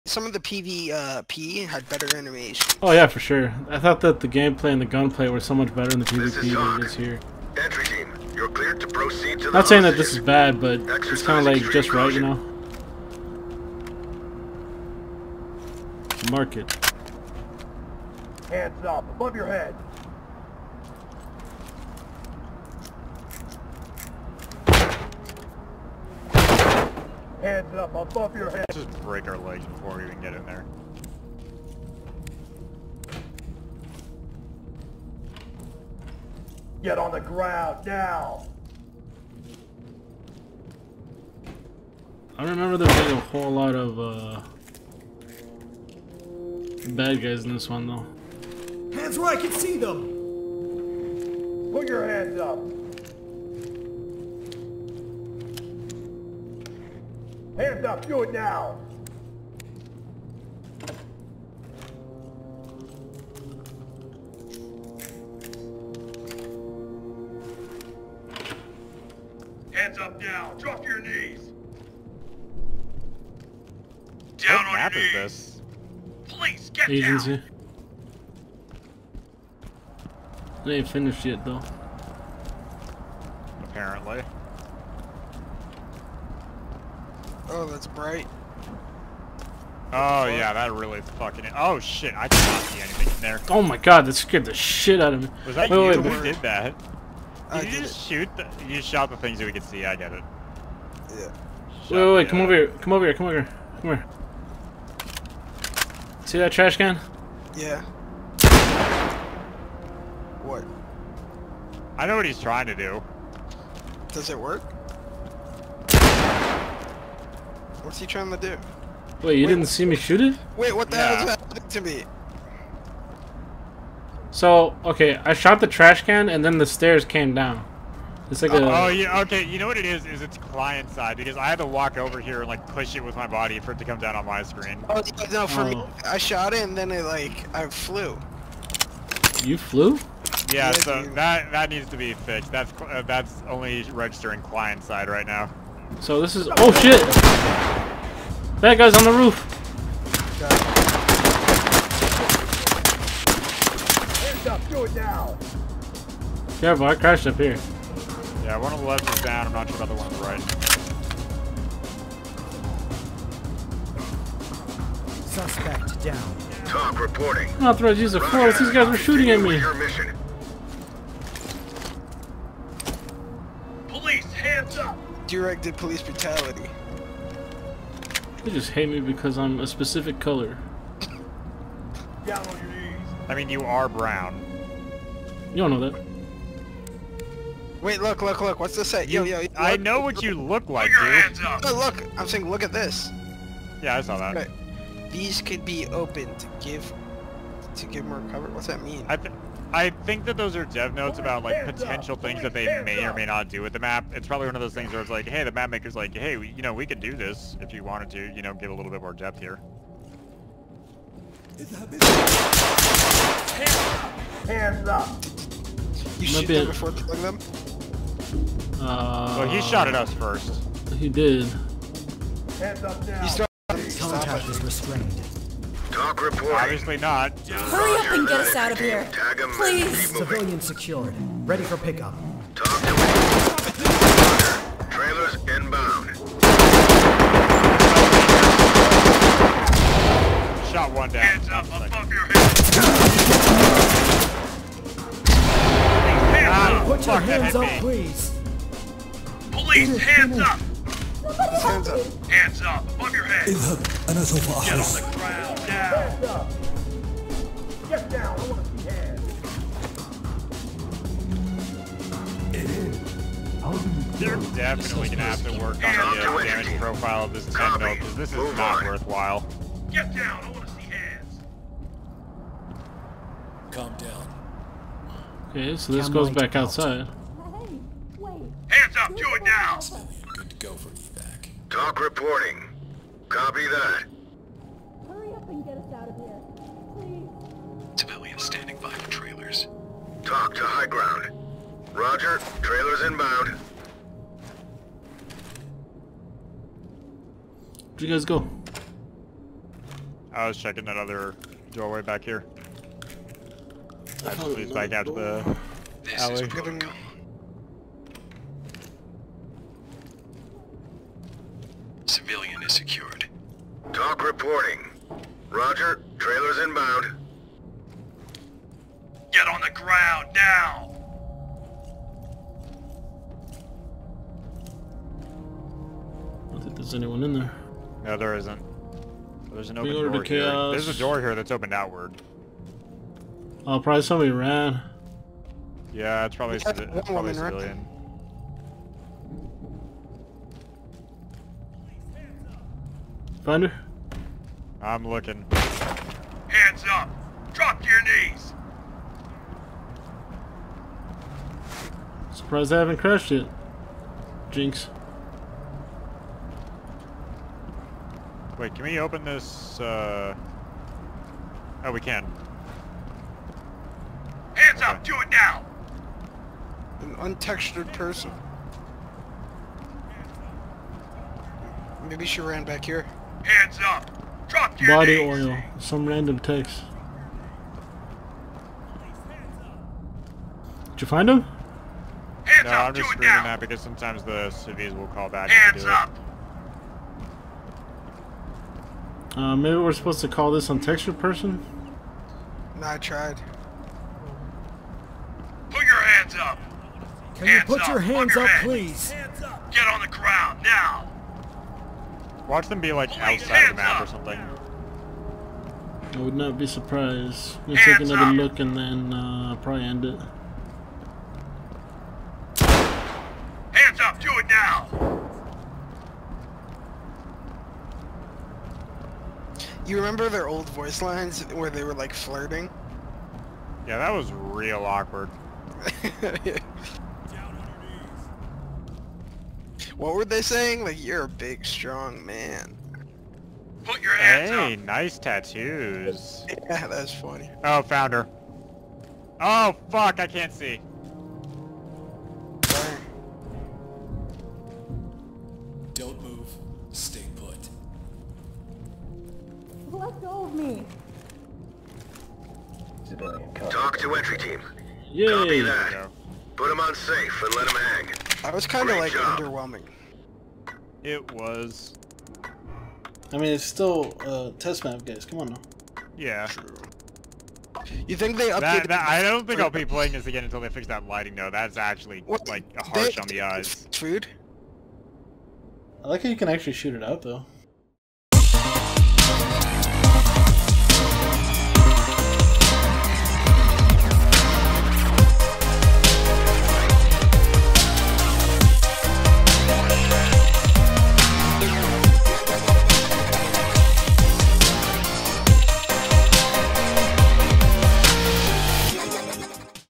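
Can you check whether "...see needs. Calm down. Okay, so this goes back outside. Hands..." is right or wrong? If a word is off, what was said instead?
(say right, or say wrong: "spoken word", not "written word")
wrong: "hands", not "needs".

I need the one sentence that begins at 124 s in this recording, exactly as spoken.
So, okay, I shot the trash can and then the stairs came down.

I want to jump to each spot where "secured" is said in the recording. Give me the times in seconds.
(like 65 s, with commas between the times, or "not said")
230 s, 312 s.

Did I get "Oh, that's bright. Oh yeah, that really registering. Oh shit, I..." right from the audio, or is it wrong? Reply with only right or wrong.
wrong.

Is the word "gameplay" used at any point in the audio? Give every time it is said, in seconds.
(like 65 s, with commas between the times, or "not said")
4 s.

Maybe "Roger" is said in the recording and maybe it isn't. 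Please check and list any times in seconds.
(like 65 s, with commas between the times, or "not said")
291 s, 315 s.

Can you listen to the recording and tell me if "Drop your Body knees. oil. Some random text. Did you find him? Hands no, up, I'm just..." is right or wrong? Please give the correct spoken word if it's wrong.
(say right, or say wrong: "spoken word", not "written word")
right.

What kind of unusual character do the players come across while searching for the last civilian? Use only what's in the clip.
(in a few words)
An untextured person.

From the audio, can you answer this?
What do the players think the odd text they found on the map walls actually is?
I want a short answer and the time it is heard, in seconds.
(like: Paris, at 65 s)
dev notes, at 200 s.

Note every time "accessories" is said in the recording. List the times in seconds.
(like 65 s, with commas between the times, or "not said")
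not said.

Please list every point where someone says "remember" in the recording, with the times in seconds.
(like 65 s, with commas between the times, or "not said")
42 s, 419 s.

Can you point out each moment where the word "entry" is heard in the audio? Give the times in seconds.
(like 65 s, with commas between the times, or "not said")
7 s, 454 s.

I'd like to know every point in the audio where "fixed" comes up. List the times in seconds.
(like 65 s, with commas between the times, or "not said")
142 s.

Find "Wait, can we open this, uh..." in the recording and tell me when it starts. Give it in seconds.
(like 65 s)
358 s.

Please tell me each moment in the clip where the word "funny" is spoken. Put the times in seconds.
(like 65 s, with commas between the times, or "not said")
437 s.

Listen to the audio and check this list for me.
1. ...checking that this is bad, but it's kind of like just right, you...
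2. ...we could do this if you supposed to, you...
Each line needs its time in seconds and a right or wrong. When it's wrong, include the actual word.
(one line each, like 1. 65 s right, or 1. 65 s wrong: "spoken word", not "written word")
1. 9 s wrong: "saying", not "checking"
2. 206 s wrong: "wanted", not "supposed".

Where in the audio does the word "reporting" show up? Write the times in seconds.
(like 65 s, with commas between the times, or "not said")
166 s, 226 s, 282 s, 314 s.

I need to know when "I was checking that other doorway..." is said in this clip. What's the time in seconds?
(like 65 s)
300 s.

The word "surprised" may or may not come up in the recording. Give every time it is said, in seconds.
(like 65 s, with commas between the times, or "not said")
352 s, 406 s.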